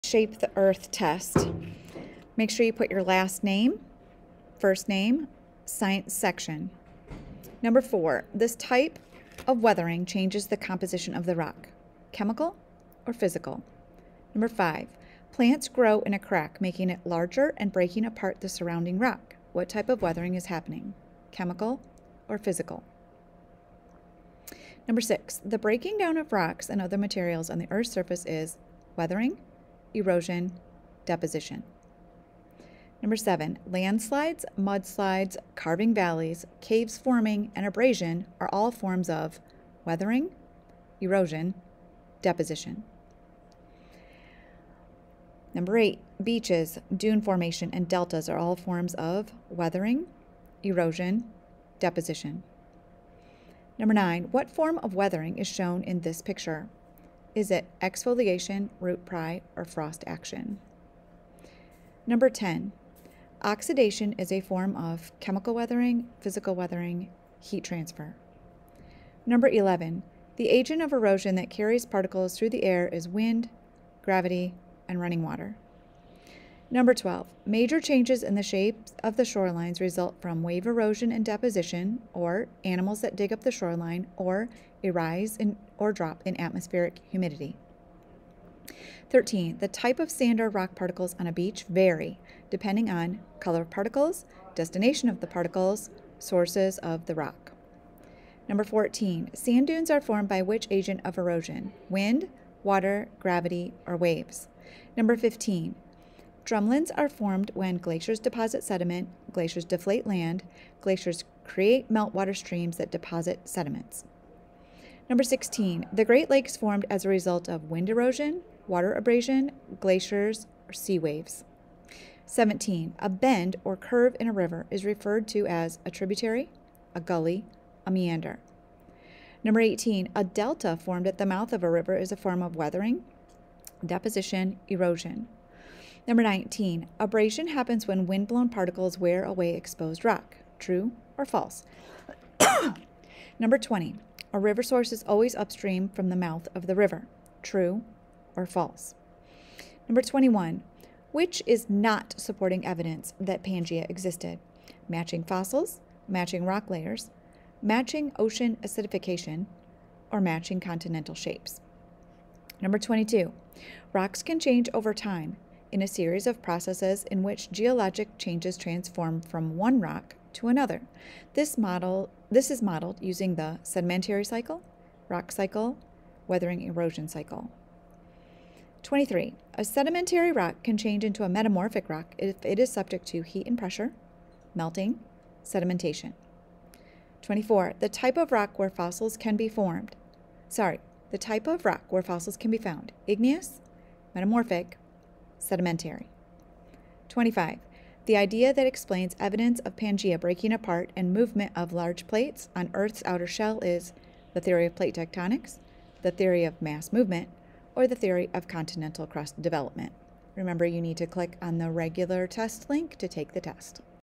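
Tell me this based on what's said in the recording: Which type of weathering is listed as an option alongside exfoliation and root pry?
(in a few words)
Frost action.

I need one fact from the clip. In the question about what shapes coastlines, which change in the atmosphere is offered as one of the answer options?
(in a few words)
Humidity.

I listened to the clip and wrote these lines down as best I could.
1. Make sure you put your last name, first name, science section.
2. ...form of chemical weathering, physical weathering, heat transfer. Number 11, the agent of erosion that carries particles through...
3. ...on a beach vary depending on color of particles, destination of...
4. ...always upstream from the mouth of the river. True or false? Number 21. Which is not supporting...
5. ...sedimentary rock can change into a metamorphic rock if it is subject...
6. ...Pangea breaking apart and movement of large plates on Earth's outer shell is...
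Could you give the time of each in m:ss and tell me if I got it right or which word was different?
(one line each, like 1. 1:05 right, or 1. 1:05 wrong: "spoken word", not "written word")
1. 0:02 right
2. 1:04 right
3. 1:31 right
4. 2:25 right
5. 2:59 right
6. 3:19 right.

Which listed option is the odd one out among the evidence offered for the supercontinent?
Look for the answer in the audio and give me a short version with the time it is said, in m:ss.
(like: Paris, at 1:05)
Matching ocean acidification, at 2:37.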